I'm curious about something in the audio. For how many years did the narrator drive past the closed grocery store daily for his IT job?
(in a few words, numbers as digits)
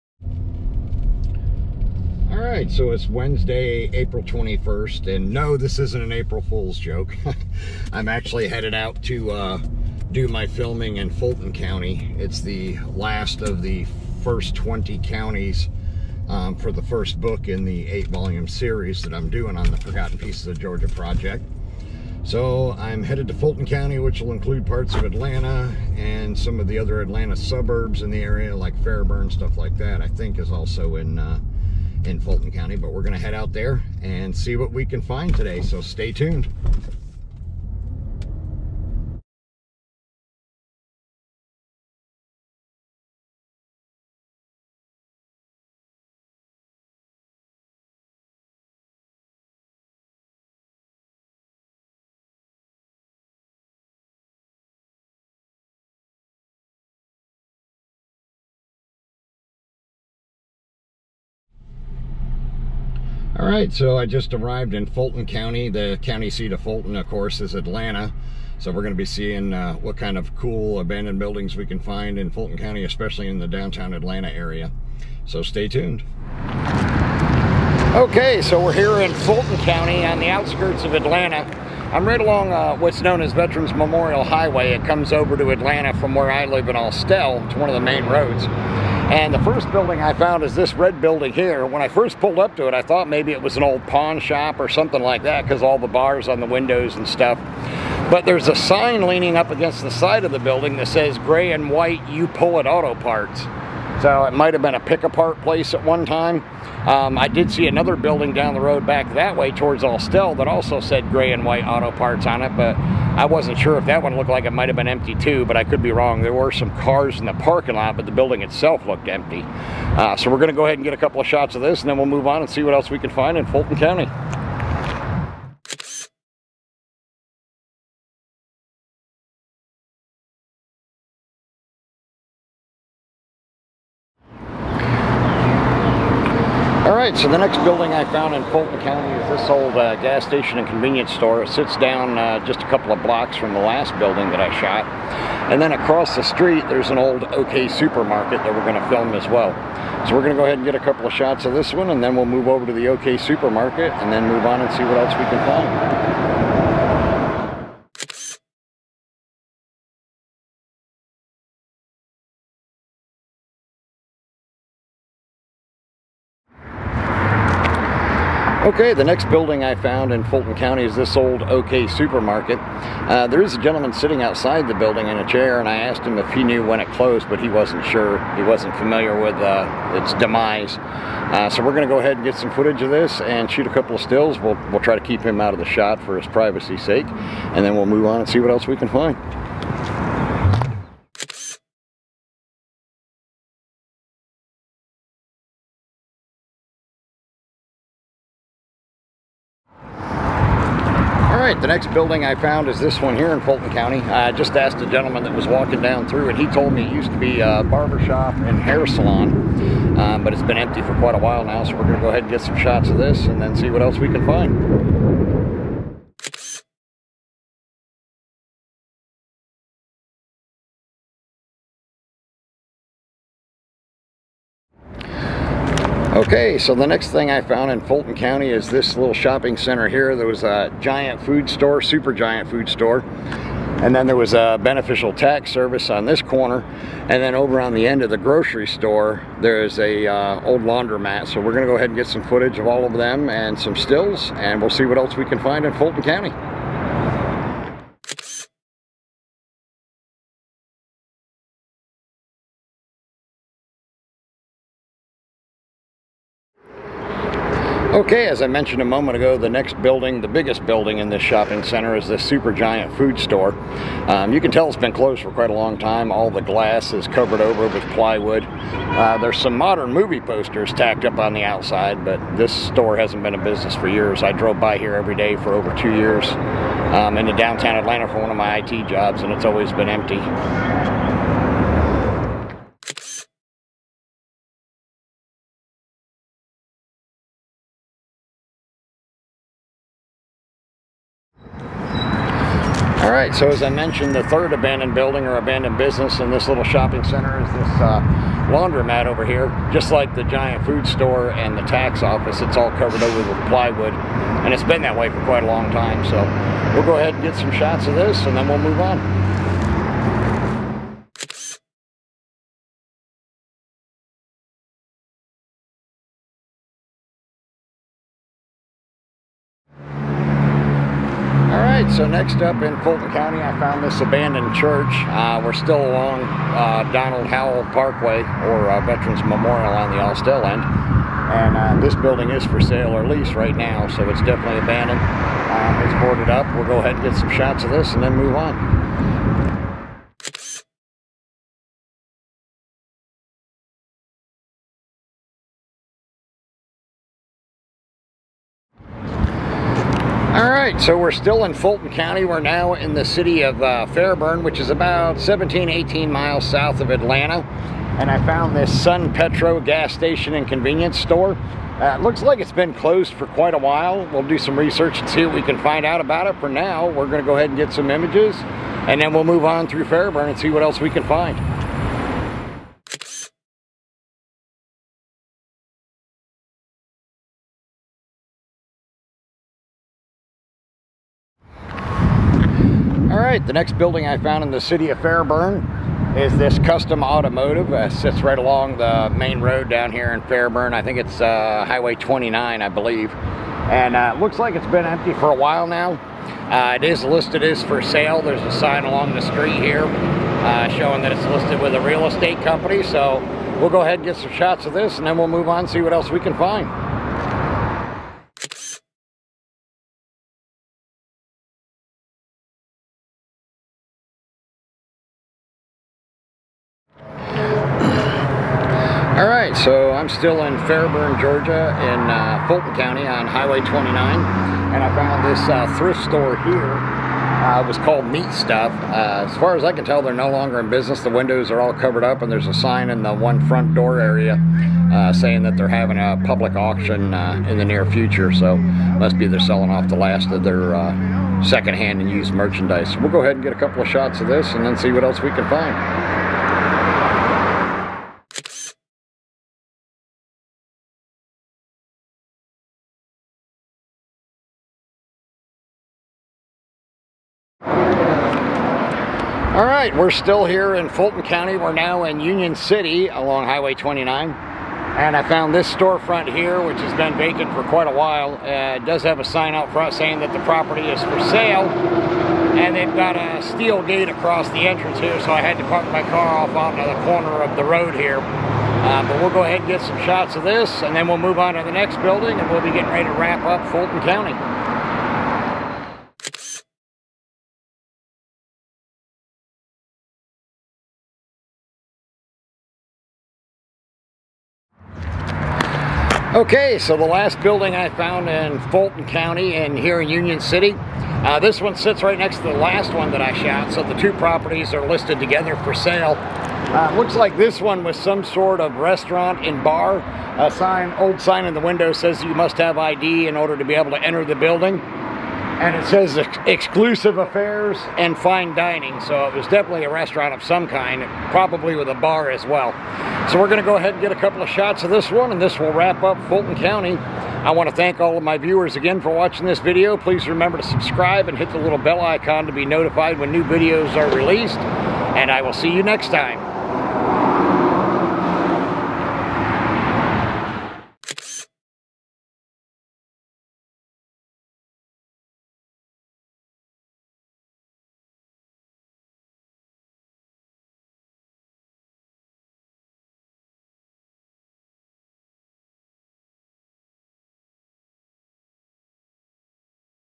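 2.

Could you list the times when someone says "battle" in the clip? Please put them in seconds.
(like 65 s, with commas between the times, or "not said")
not said.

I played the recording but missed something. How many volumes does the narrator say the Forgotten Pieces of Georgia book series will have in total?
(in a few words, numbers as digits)
8.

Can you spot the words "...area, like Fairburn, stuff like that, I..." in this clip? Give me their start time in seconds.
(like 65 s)
28 s.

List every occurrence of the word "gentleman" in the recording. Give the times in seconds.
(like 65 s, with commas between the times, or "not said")
173 s, 204 s.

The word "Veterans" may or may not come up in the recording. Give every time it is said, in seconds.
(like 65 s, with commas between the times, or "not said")
83 s, 328 s.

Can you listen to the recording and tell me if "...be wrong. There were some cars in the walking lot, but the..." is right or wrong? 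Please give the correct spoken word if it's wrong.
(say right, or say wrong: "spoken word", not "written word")
wrong: "parking", not "walking".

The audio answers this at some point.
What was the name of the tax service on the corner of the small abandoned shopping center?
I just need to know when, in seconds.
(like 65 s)
234 s.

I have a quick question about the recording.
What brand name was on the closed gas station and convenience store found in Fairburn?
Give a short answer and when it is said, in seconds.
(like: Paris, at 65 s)
Sun Petro, at 358 s.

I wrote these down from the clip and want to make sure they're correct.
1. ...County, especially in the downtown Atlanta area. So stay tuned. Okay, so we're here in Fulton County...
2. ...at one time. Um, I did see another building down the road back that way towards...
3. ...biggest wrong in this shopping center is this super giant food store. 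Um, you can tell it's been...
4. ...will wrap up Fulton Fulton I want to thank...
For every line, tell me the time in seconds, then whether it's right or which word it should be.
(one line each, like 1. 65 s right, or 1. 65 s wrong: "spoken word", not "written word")
1. 72 s right
2. 105 s right
3. 260 s wrong: "building", not "wrong"
4. 525 s wrong: "County", not "Fulton".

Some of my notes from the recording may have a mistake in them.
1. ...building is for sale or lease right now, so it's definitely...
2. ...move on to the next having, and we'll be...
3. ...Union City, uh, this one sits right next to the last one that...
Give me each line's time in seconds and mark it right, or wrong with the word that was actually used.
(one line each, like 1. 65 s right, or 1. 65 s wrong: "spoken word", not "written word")
1. 331 s right
2. 481 s wrong: "building", not "having"
3. 500 s right.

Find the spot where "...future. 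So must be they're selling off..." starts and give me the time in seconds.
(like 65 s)
437 s.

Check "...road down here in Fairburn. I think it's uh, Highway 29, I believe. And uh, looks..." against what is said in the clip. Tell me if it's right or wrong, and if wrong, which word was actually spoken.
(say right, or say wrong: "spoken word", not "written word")
right.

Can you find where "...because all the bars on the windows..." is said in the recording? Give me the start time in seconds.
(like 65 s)
95 s.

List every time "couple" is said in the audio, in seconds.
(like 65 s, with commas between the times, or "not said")
120 s, 142 s, 150 s, 183 s, 443 s, 524 s.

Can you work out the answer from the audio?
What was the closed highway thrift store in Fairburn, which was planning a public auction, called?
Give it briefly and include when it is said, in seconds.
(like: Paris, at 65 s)
Meat Stuff, at 428 s.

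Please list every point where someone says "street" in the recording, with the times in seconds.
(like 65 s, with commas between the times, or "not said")
146 s, 399 s.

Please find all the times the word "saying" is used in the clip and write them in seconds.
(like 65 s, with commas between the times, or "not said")
435 s, 469 s.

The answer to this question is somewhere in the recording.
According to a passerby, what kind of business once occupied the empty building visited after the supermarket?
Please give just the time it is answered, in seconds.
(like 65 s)
207 s.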